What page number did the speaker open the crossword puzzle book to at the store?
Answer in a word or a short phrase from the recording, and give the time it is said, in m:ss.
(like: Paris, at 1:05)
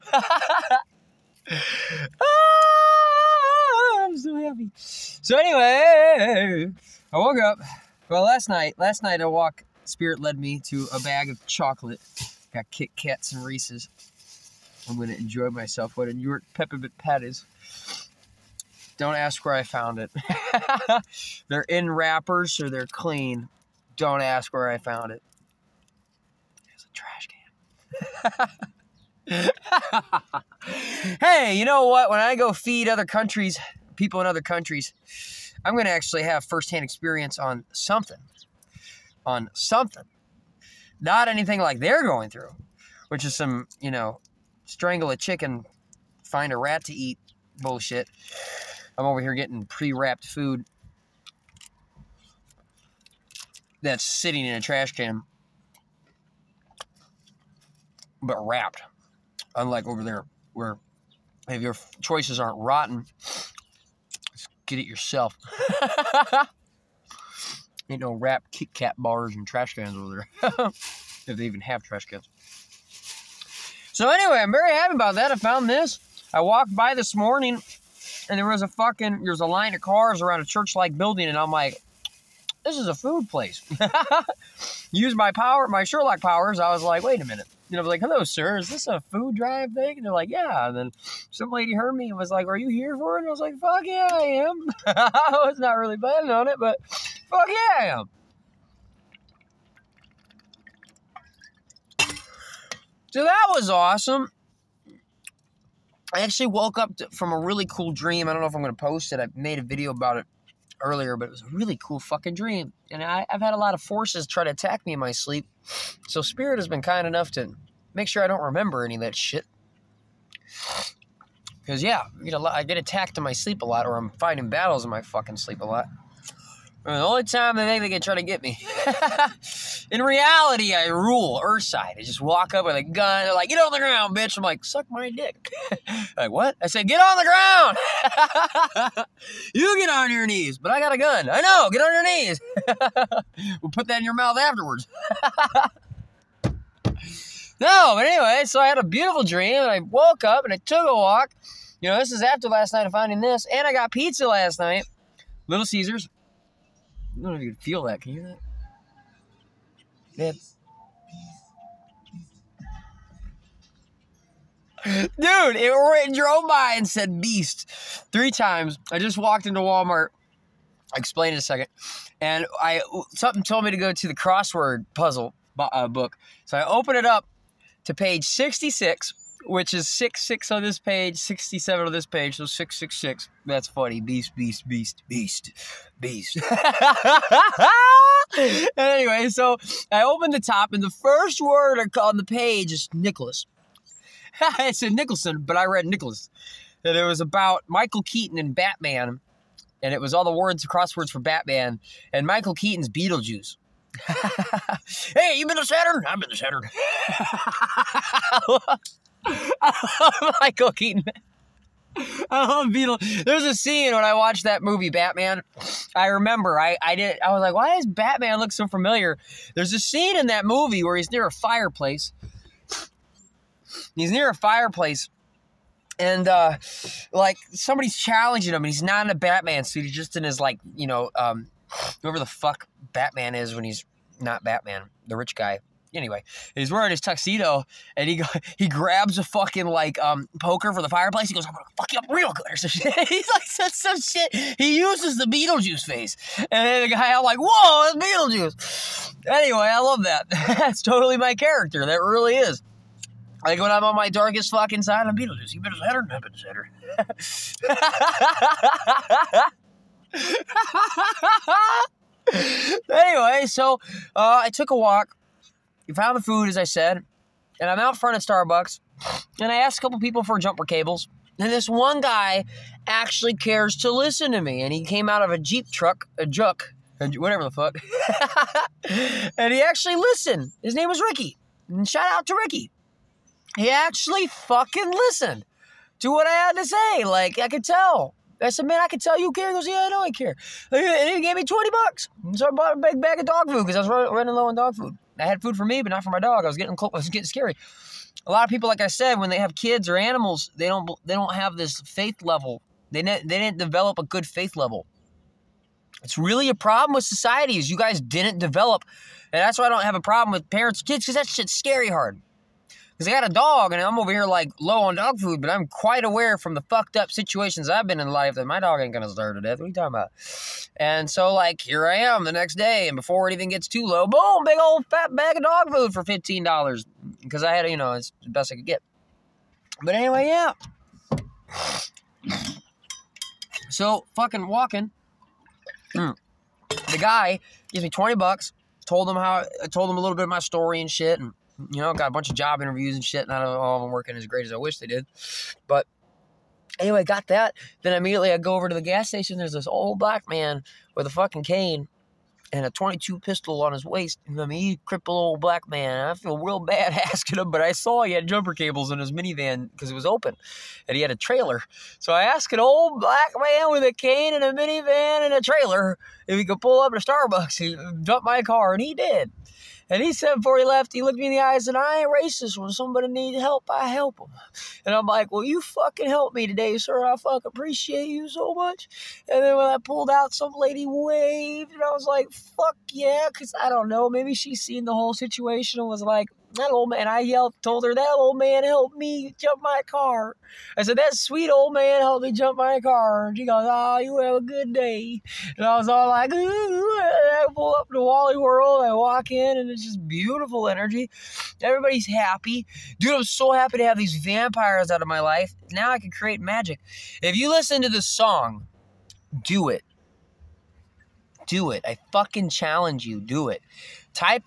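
66, at 2:58.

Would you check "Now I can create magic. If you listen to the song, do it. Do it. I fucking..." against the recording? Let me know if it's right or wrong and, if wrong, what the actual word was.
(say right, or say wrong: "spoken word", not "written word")
right.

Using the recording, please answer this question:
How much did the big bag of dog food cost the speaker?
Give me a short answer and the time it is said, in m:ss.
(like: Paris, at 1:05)
$15, at 5:26.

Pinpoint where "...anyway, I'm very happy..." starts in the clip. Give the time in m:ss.
1:14.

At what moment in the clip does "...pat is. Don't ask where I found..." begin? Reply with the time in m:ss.
0:16.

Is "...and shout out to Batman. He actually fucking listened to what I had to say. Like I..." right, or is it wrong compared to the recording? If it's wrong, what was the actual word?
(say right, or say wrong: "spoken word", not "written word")
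wrong: "Ricky", not "Batman".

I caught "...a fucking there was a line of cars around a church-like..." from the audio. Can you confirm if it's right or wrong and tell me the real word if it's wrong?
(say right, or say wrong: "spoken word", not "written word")
right.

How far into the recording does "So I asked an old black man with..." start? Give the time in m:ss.
6:01.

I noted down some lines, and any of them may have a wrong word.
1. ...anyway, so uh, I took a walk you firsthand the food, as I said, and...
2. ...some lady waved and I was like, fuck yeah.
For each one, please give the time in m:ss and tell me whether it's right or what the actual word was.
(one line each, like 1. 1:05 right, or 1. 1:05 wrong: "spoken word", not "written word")
1. 4:22 wrong: "found", not "firsthand"
2. 6:20 right.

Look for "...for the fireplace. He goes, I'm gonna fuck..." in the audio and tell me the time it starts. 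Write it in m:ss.
4:00.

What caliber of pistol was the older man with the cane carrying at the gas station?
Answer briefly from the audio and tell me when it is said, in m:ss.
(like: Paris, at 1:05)
22, at 5:52.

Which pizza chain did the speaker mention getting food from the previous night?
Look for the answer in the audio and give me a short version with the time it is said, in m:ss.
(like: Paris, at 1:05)
Little Caesars, at 2:35.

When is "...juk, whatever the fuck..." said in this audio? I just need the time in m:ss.
4:36.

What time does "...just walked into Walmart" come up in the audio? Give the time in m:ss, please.
2:48.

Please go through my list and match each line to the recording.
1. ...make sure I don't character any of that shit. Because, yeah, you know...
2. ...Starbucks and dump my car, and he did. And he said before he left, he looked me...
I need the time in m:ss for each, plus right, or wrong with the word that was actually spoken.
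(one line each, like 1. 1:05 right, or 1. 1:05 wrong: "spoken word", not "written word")
1. 1:57 wrong: "remember", not "character"
2. 6:06 right.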